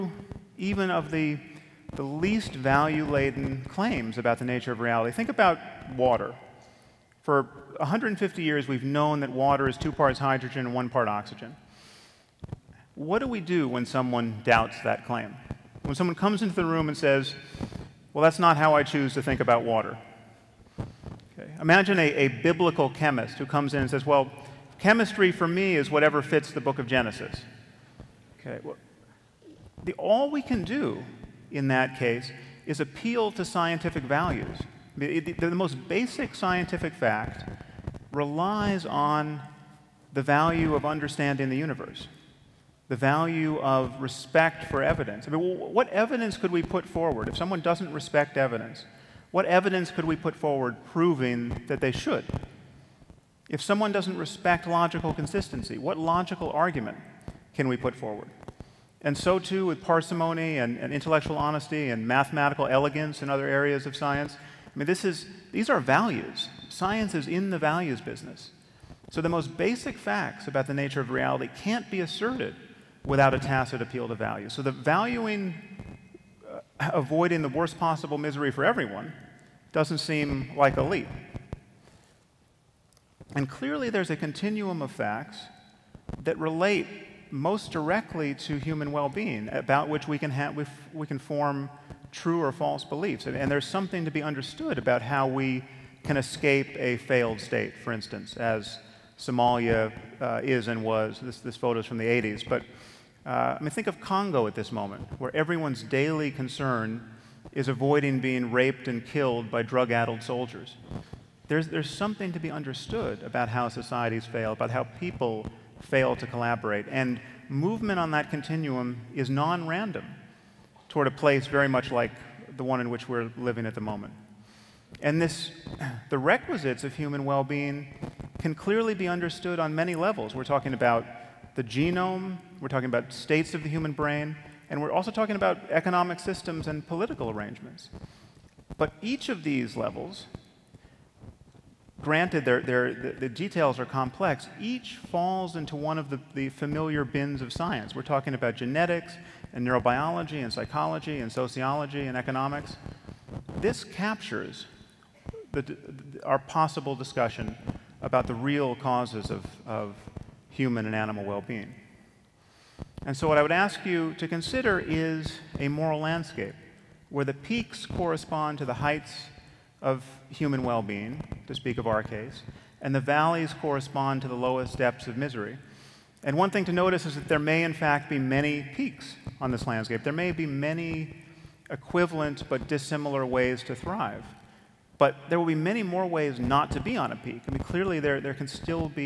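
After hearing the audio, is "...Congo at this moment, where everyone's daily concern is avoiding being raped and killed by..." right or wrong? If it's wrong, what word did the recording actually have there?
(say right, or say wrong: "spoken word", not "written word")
right.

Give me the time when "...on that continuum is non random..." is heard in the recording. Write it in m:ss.
1:57.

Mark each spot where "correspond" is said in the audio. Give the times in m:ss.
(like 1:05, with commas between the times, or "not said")
2:47, 2:53.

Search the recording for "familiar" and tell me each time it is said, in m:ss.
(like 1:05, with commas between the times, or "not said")
2:26.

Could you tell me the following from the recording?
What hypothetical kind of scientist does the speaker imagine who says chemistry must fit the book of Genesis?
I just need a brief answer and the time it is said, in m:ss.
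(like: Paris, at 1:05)
biblical chemist, at 0:22.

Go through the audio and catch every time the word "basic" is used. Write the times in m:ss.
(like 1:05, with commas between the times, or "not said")
0:35, 1:09.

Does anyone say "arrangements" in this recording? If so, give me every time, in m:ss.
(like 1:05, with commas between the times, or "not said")
2:17.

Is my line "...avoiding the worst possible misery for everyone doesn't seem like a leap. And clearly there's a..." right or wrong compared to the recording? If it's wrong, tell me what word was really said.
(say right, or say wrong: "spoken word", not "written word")
right.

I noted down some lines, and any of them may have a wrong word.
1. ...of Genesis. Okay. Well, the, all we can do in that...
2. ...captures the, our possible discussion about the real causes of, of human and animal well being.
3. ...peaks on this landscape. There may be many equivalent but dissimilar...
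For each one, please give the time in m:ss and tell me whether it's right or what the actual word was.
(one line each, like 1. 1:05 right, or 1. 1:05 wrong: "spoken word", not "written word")
1. 0:26 right
2. 2:33 right
3. 2:58 right.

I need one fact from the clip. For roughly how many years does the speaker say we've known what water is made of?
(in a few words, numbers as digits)
150 years.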